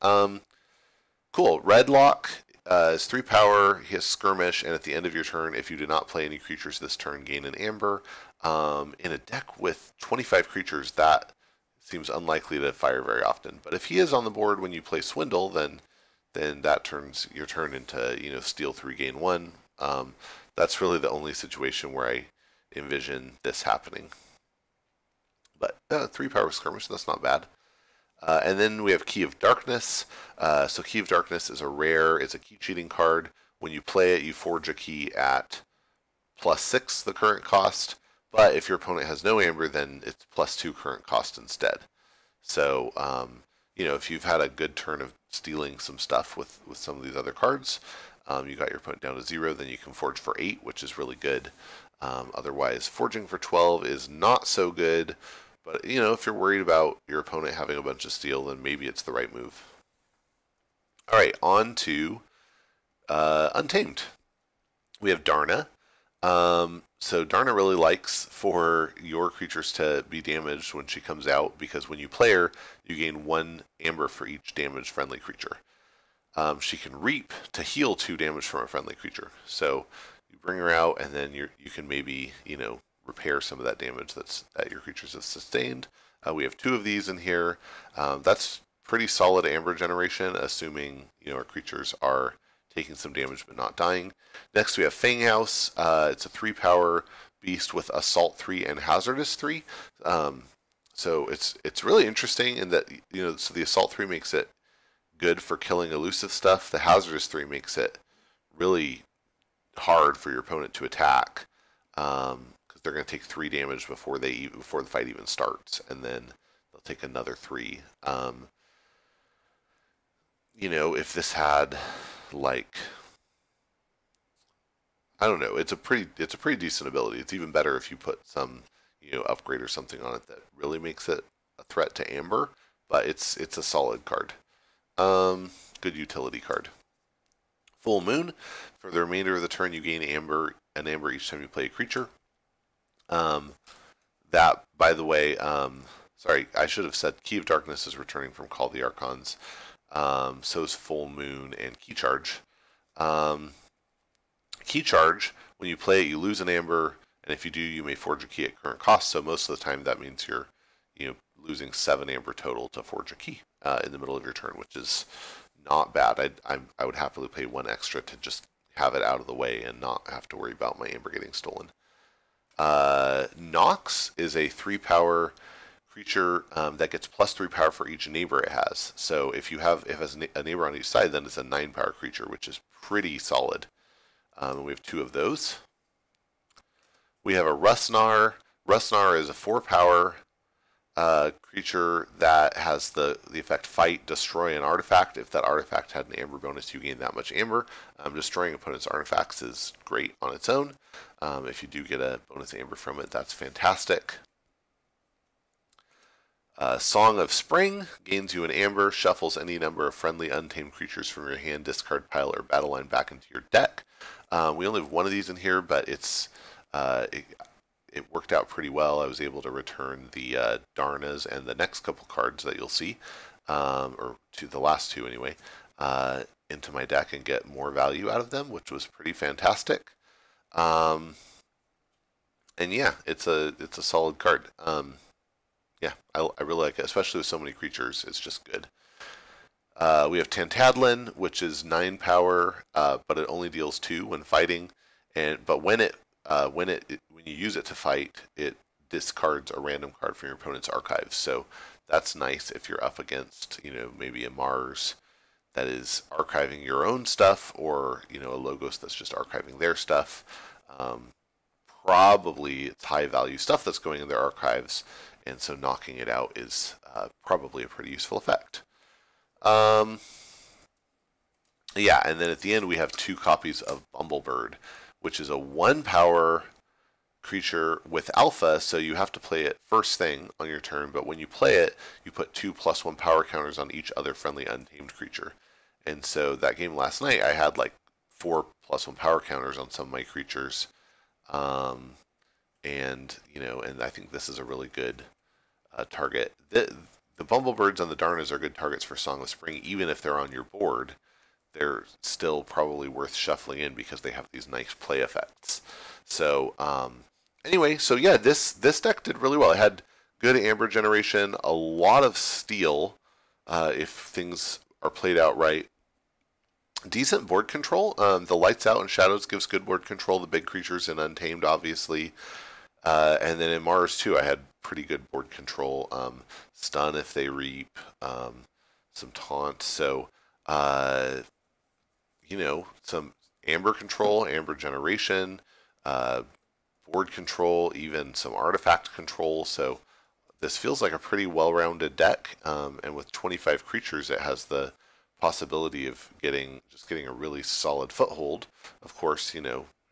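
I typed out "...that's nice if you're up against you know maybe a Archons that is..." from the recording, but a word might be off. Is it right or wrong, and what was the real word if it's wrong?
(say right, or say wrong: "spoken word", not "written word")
wrong: "Mars", not "Archons".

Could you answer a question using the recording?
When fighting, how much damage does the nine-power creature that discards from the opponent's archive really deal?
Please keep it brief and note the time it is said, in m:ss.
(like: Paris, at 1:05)
2, at 4:03.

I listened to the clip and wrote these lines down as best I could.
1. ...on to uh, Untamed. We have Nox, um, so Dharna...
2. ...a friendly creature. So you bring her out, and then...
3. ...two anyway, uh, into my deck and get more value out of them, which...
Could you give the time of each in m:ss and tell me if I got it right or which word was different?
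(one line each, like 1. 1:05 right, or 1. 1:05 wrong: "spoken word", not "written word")
1. 1:01 wrong: "Dharna", not "Nox"
2. 1:18 right
3. 3:44 right.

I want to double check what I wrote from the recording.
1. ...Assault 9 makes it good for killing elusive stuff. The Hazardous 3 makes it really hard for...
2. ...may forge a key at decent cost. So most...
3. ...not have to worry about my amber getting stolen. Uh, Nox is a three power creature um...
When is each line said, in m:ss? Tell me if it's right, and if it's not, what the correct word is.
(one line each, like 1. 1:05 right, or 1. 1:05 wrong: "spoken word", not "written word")
1. 1:43 wrong: "3", not "9"
2. 2:37 wrong: "current", not "decent"
3. 2:49 right.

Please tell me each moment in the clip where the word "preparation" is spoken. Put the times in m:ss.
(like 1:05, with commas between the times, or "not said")
not said.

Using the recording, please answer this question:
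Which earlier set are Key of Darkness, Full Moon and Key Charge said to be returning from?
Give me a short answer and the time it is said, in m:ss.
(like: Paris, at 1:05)
Call the Archons, at 2:28.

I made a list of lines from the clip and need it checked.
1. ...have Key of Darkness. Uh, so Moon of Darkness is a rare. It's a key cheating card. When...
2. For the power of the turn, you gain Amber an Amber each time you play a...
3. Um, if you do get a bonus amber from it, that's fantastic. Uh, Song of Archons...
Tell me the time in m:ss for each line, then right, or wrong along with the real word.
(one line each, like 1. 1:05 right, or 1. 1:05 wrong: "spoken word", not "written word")
1. 0:28 wrong: "Key", not "Moon"
2. 2:18 wrong: "remainder", not "power"
3. 3:21 wrong: "Spring", not "Archons".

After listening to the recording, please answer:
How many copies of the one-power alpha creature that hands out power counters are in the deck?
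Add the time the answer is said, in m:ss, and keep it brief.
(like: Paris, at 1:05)
2, at 4:32.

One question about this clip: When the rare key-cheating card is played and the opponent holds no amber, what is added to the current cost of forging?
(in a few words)
2.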